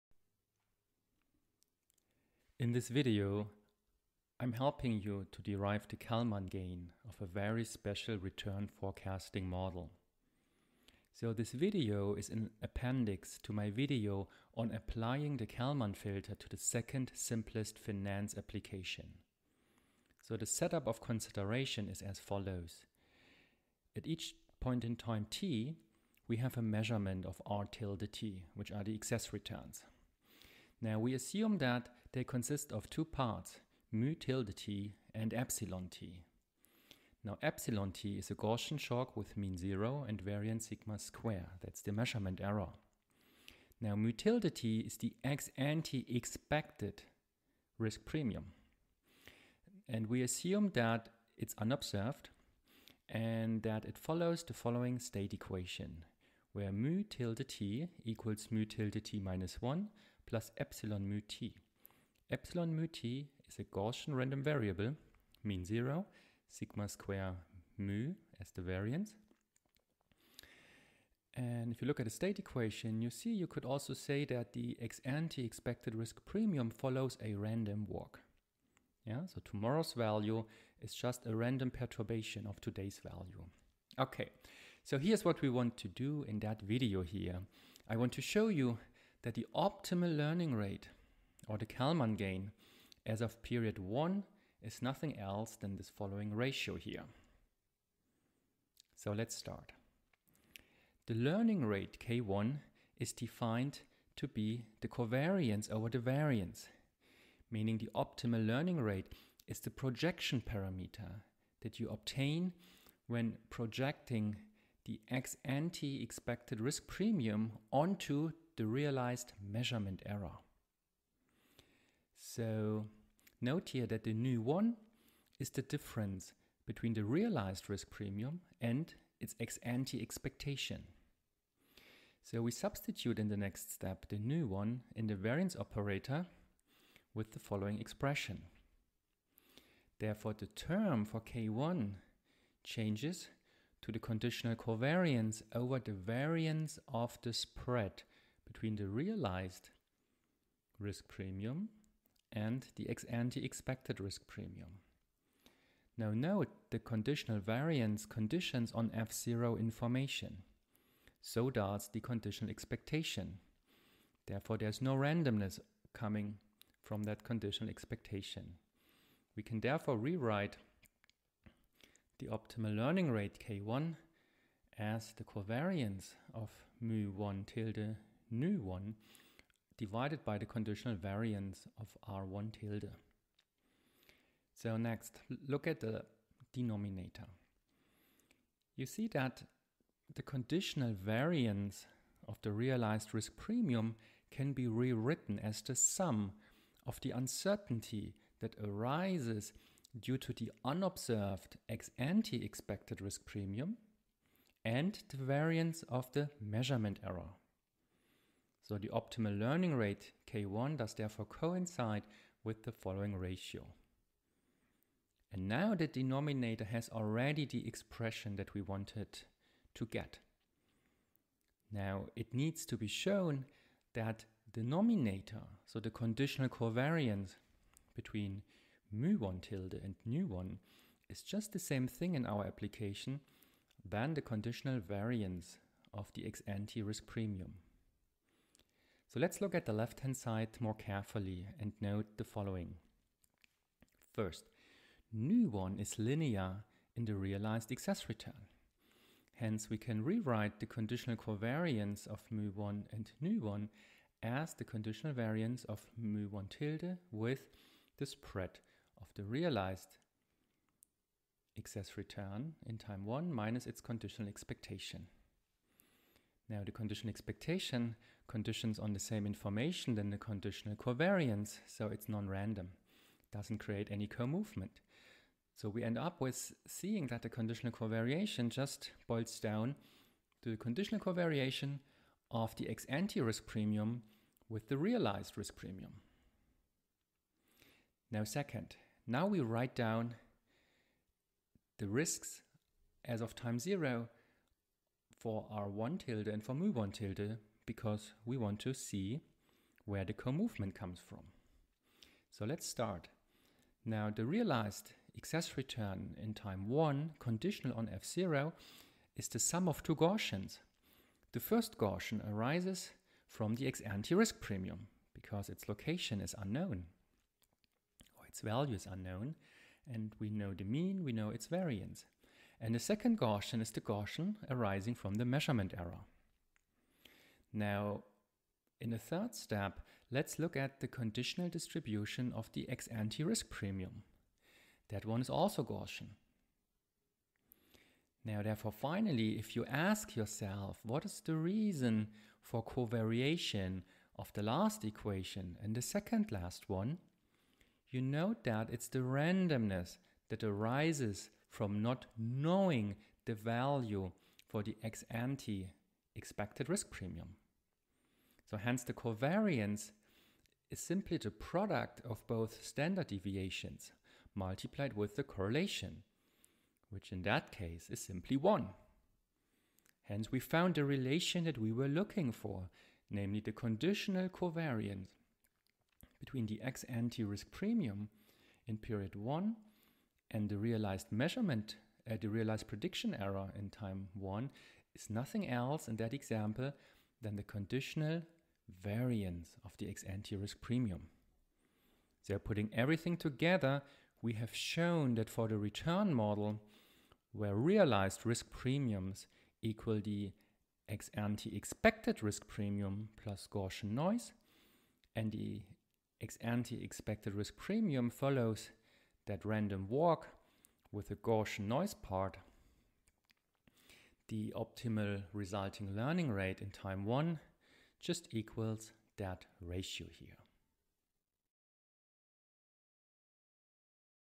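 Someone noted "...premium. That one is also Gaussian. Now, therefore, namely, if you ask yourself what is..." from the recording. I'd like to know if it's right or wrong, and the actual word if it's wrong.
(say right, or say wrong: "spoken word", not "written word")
wrong: "finally", not "namely".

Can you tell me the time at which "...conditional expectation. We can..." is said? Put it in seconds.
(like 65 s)
167 s.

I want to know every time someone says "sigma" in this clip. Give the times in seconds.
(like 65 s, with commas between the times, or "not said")
40 s, 66 s.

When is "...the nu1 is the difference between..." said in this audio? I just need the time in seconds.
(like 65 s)
124 s.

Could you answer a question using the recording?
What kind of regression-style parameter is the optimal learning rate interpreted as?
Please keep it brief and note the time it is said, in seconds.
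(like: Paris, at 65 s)
Projection parameter, at 109 s.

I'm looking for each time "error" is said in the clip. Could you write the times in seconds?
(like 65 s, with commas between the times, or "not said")
42 s, 120 s, 207 s, 325 s, 383 s.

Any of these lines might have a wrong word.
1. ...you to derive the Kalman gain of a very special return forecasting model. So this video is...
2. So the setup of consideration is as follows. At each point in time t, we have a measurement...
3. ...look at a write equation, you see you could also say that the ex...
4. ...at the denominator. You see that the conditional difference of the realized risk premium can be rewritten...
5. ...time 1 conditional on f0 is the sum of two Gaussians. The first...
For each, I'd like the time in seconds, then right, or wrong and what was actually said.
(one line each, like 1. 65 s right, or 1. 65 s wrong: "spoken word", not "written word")
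1. 5 s right
2. 20 s right
3. 71 s wrong: "state", not "write"
4. 185 s wrong: "variance", not "difference"
5. 306 s right.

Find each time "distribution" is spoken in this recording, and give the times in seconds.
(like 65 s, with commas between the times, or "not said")
331 s.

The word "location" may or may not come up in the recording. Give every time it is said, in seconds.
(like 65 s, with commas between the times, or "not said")
315 s.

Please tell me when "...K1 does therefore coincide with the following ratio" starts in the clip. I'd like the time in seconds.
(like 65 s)
210 s.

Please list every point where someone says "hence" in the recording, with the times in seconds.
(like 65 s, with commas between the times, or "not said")
249 s, 358 s, 370 s.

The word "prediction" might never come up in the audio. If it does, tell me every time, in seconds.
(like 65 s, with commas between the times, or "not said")
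382 s.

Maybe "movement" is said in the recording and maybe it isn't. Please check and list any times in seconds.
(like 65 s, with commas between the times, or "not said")
274 s, 300 s.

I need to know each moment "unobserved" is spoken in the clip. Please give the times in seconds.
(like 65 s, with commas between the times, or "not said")
51 s, 200 s.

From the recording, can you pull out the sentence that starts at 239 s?
So let's look at the left-hand side more carefully and note the following.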